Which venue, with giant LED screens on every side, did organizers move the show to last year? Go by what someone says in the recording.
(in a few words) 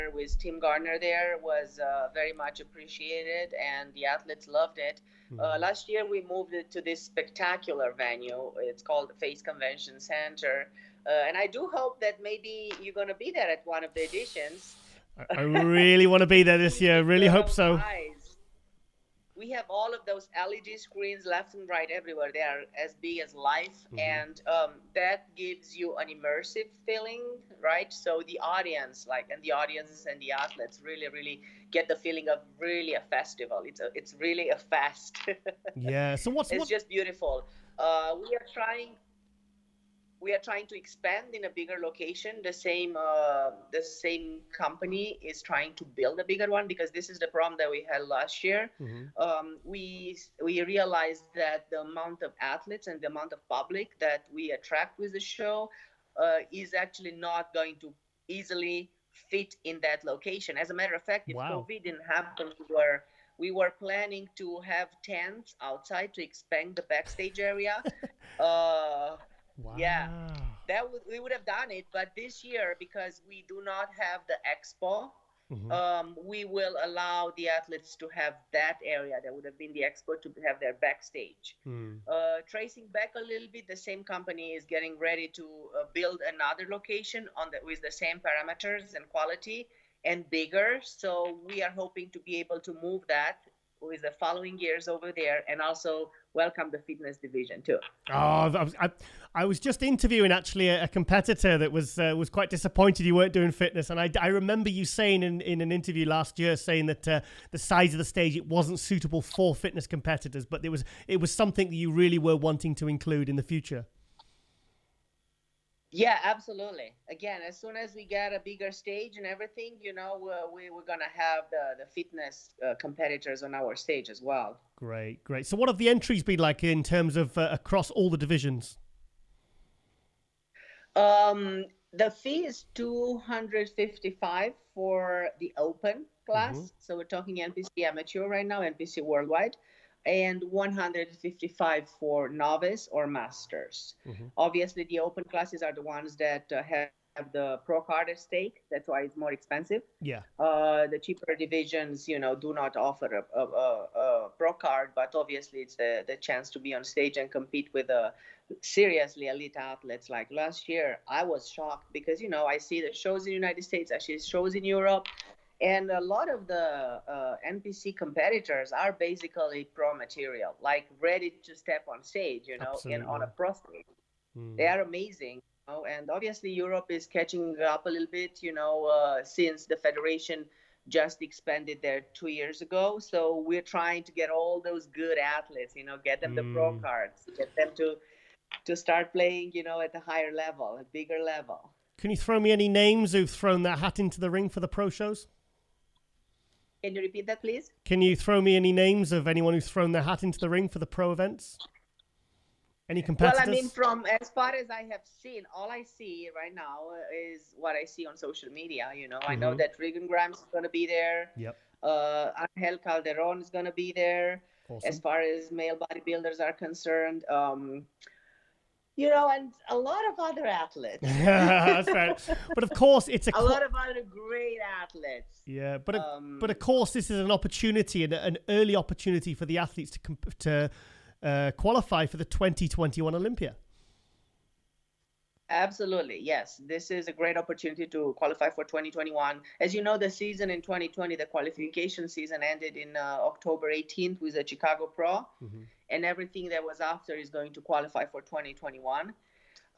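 Face Convention Center.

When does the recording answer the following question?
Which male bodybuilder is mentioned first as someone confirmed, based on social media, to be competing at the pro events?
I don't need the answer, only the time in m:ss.
3:29.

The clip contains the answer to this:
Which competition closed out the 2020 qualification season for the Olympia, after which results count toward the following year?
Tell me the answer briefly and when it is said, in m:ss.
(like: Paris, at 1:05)
Chicago Pro, at 4:04.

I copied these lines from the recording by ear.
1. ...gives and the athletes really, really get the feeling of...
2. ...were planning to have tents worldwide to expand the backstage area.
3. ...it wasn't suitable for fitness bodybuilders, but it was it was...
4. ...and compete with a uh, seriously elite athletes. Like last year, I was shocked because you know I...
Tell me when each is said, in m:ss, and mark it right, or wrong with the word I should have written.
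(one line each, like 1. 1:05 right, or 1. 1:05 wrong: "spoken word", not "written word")
1. 0:29 wrong: "audiences", not "gives"
2. 1:03 wrong: "outside", not "worldwide"
3. 1:48 wrong: "competitors", not "bodybuilders"
4. 2:37 right.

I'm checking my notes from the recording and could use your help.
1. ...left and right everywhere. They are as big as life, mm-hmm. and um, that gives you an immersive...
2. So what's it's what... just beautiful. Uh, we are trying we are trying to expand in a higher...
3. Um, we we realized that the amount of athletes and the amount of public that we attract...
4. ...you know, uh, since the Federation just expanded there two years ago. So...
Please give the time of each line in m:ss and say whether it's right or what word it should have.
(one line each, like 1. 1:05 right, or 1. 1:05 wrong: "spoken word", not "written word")
1. 0:21 right
2. 0:36 wrong: "bigger", not "higher"
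3. 0:49 right
4. 2:58 right.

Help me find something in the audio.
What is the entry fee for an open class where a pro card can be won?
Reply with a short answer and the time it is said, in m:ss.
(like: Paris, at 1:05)
$255, at 2:12.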